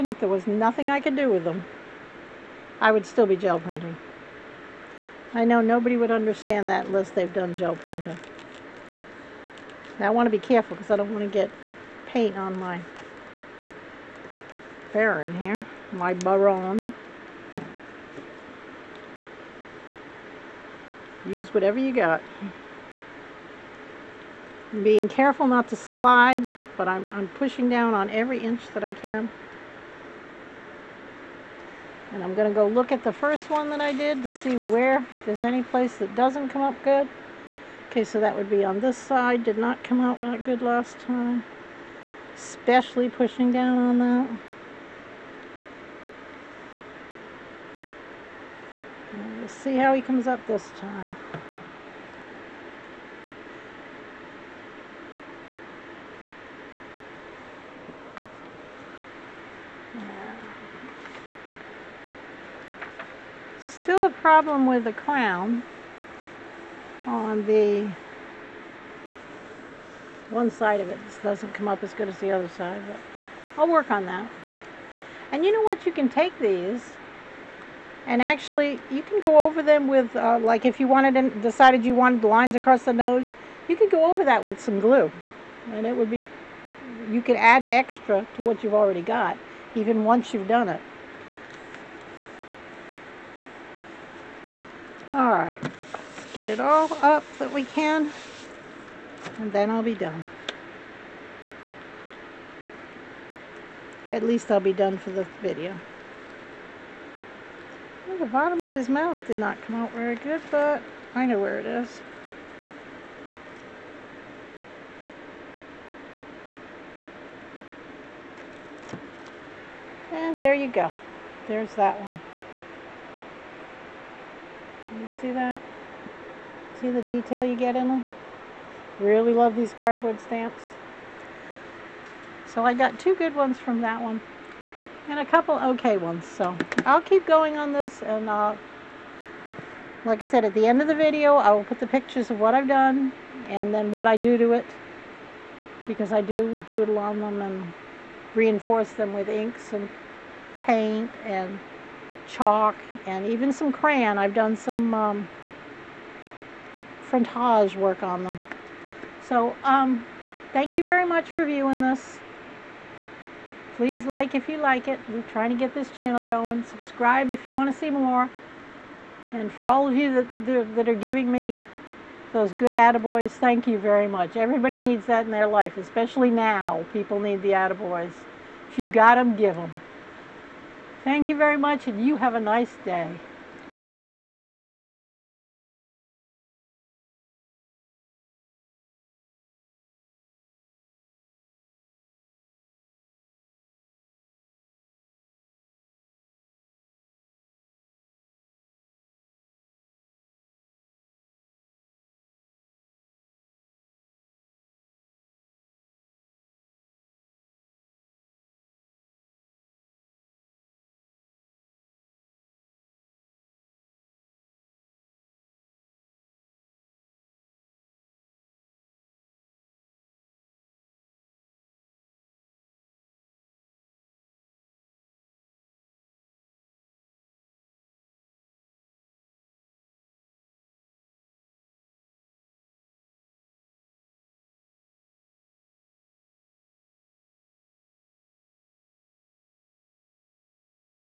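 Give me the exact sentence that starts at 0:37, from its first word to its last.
Okay, so that would be on this side.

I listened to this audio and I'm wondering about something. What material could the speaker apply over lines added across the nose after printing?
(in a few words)
glue.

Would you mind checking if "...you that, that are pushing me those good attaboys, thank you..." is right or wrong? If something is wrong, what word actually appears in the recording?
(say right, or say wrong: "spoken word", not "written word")
wrong: "giving", not "pushing".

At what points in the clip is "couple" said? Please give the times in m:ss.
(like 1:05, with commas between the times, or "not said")
2:15.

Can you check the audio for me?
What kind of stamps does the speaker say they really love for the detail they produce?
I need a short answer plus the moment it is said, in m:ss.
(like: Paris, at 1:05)
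cardboard stamps, at 2:09.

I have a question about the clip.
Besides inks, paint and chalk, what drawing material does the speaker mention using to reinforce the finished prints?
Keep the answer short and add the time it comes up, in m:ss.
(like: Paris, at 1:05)
crayon, at 2:33.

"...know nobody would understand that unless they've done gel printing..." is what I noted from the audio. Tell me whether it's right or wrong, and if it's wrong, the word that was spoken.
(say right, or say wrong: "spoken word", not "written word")
right.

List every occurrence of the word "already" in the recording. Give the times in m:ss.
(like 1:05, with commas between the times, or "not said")
1:28.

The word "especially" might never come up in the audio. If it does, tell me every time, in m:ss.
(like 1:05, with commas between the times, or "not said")
0:42, 2:55.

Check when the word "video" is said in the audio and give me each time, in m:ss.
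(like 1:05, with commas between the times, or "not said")
1:45, 2:20.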